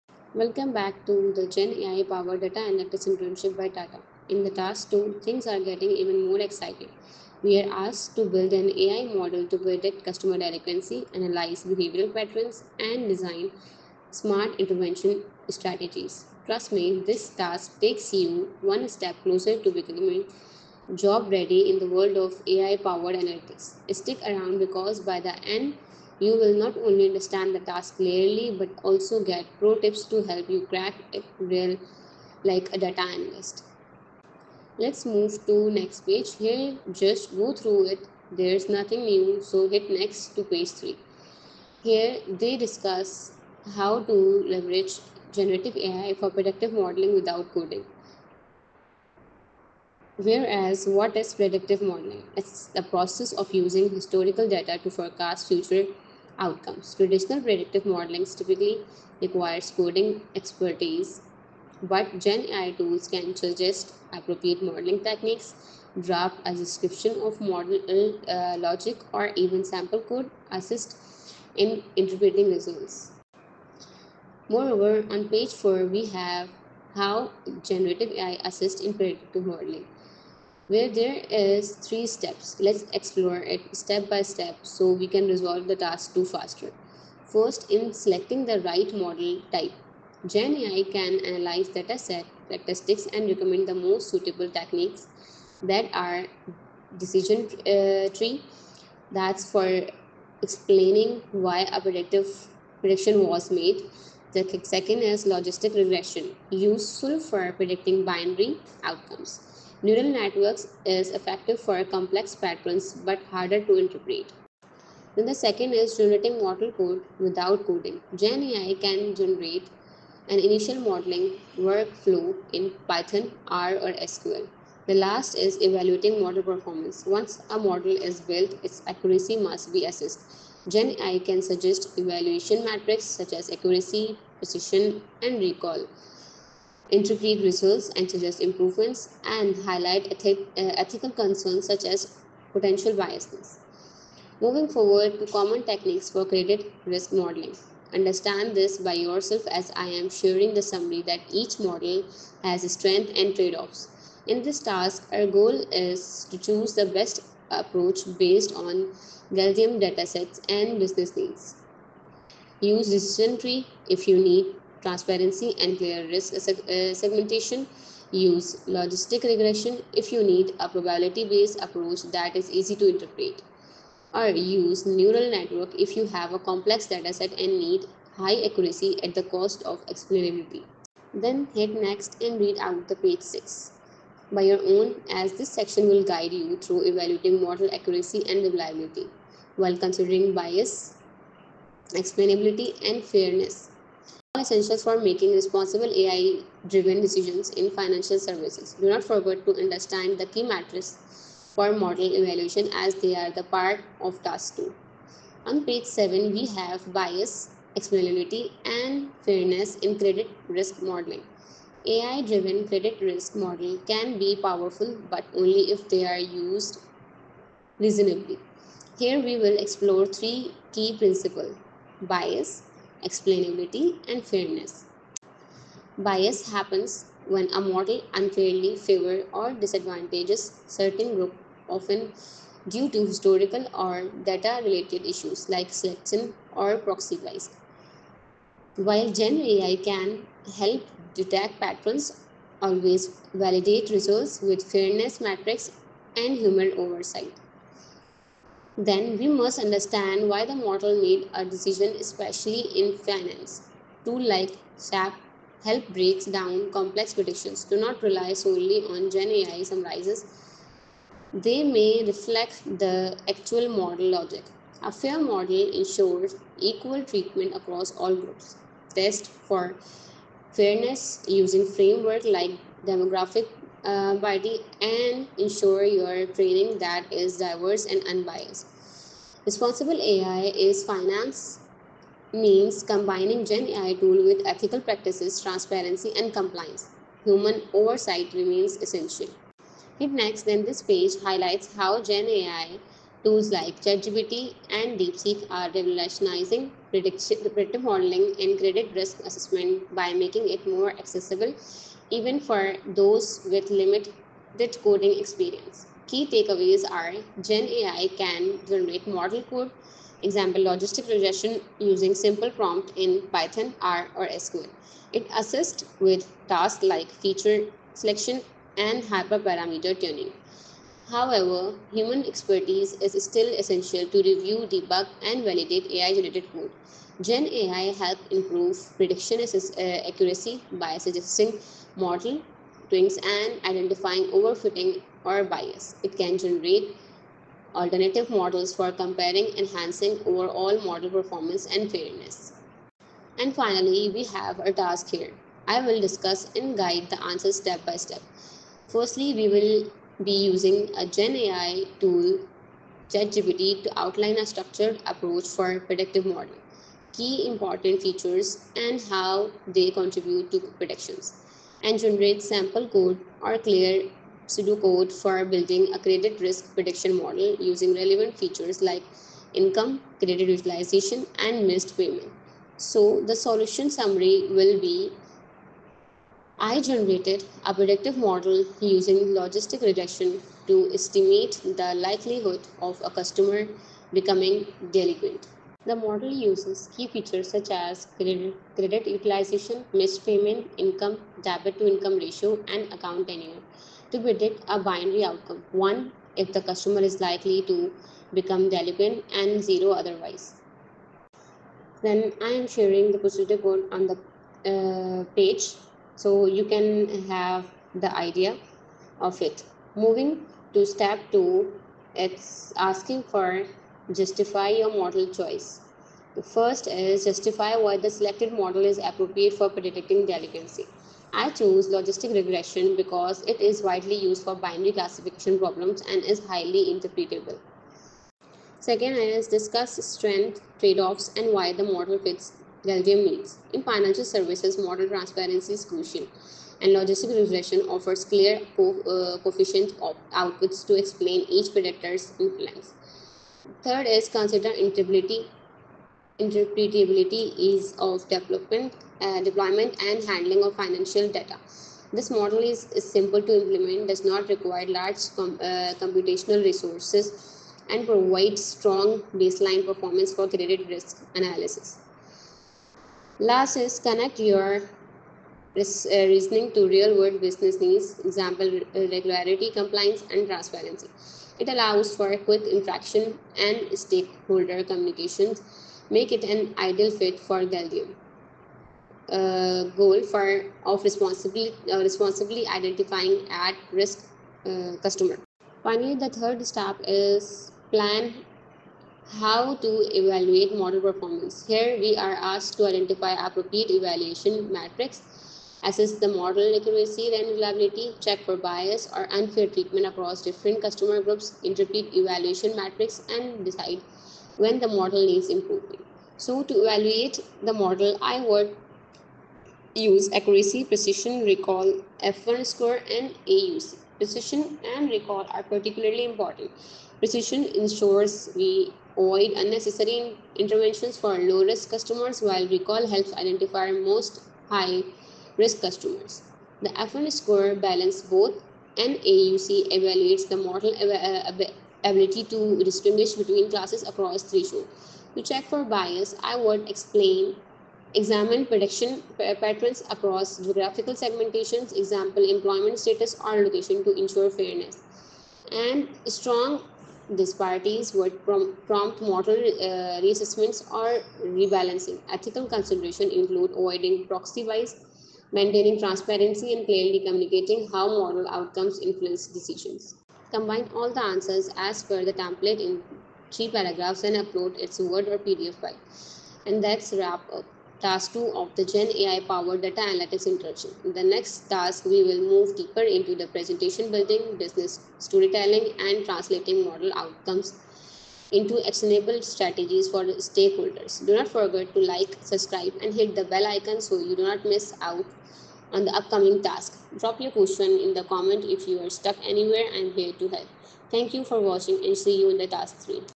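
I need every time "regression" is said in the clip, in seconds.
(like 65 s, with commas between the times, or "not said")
105 s, 169 s, 311 s, 379 s, 422 s, 437 s.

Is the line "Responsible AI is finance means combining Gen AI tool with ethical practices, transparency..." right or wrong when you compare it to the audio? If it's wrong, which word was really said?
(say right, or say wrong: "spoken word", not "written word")
right.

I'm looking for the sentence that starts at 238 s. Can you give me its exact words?
While Gen AI can help detect patterns, always validate results with fairness metrics and human oversight.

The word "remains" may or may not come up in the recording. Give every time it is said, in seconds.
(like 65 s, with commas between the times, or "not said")
288 s.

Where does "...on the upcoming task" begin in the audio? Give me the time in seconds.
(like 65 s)
585 s.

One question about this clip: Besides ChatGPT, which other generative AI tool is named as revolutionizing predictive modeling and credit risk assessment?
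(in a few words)
DeepSeek.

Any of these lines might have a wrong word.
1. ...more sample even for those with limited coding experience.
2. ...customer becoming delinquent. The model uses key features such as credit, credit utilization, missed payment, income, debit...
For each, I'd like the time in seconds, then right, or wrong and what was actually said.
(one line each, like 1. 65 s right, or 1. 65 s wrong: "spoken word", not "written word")
1. 300 s wrong: "accessible", not "sample"
2. 383 s right.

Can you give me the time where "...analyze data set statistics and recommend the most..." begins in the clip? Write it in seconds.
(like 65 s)
91 s.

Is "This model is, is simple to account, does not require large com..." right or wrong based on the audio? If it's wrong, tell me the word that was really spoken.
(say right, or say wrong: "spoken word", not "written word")
wrong: "implement", not "account".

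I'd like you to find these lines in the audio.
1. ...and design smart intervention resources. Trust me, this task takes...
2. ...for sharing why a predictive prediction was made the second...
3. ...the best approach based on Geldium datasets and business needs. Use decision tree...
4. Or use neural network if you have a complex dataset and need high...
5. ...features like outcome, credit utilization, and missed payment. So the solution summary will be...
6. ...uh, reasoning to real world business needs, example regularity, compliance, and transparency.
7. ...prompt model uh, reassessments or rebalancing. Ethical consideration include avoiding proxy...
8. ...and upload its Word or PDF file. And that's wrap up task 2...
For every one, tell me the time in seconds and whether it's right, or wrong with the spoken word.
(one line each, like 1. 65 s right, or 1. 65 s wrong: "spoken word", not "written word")
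1. 12 s wrong: "strategies", not "resources"
2. 99 s wrong: "explaining", not "sharing"
3. 156 s right
4. 174 s right
5. 368 s wrong: "income", not "outcome"
6. 464 s right
7. 548 s right
8. 564 s right.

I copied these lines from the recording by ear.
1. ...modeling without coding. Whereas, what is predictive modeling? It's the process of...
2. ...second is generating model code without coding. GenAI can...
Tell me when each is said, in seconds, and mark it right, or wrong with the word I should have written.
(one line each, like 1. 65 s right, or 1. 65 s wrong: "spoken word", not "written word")
1. 46 s right
2. 115 s right.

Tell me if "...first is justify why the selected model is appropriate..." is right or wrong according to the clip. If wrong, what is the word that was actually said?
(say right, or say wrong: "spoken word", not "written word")
right.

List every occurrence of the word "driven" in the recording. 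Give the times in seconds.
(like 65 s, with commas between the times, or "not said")
195 s, 211 s.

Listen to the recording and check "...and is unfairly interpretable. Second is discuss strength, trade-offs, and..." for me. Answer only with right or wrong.
wrong.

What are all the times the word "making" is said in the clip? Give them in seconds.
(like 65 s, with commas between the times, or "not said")
194 s, 300 s.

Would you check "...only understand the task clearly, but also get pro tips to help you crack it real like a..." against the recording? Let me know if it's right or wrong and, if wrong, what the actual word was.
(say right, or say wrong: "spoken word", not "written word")
right.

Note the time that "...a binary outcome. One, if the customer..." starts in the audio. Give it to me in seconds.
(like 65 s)
394 s.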